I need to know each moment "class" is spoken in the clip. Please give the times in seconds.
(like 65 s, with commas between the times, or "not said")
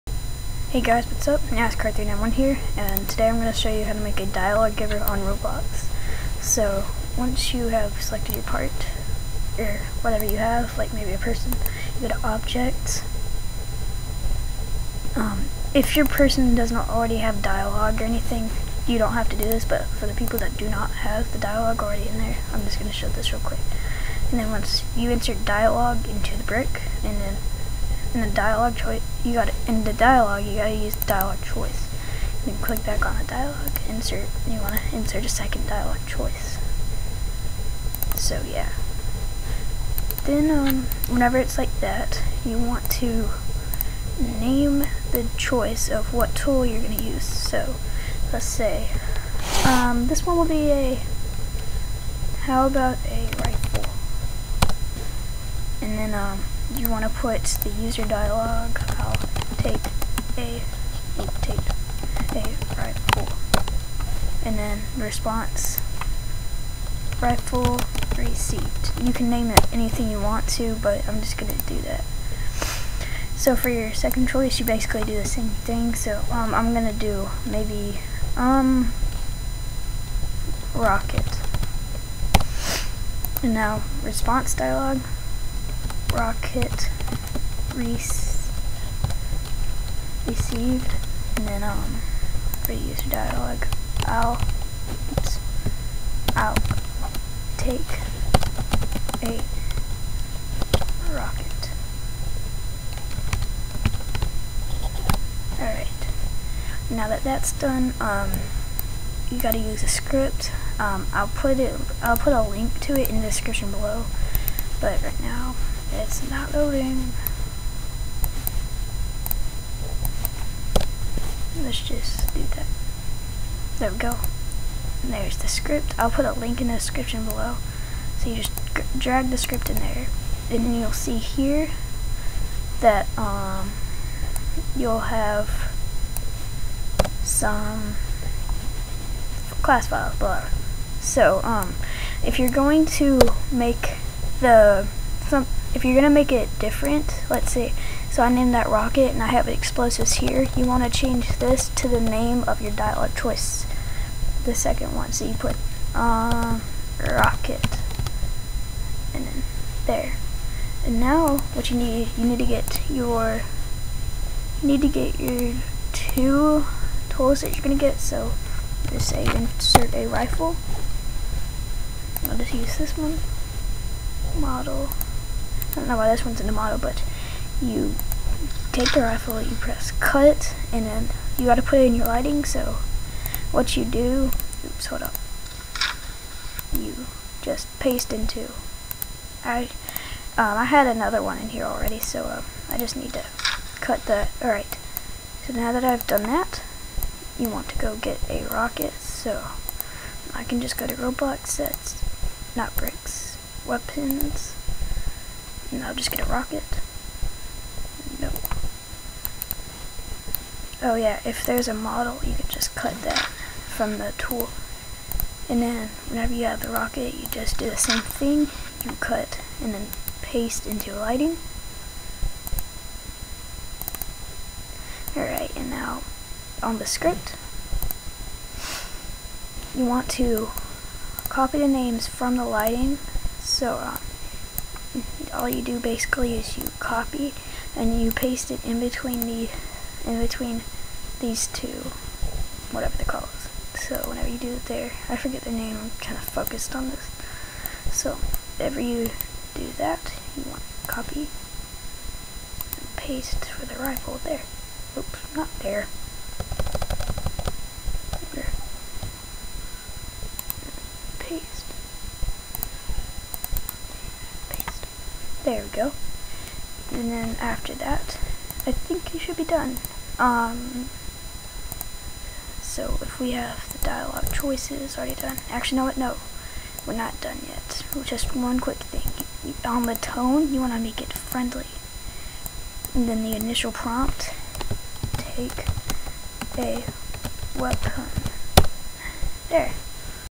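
139 s.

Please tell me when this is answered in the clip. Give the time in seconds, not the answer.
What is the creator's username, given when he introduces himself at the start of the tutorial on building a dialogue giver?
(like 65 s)
1 s.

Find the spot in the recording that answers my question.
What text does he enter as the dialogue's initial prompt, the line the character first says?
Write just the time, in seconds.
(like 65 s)
285 s.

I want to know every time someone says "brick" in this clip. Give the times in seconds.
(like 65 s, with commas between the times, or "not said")
26 s, 202 s.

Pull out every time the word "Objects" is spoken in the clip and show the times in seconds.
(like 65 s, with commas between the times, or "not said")
12 s.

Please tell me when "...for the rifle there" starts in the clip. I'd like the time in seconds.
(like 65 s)
253 s.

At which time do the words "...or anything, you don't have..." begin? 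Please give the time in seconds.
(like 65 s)
17 s.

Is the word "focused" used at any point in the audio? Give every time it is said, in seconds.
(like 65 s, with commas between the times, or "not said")
246 s.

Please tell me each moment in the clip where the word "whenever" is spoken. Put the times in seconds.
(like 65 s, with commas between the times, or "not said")
41 s, 216 s, 244 s, 248 s.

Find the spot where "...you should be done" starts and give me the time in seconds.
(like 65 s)
269 s.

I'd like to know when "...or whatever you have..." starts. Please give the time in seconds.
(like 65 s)
9 s.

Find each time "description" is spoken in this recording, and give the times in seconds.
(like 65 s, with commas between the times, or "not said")
113 s, 126 s.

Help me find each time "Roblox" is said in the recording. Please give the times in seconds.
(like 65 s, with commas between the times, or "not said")
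5 s, 200 s.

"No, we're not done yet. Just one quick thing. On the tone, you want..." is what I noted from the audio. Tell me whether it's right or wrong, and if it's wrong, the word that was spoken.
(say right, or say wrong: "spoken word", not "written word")
right.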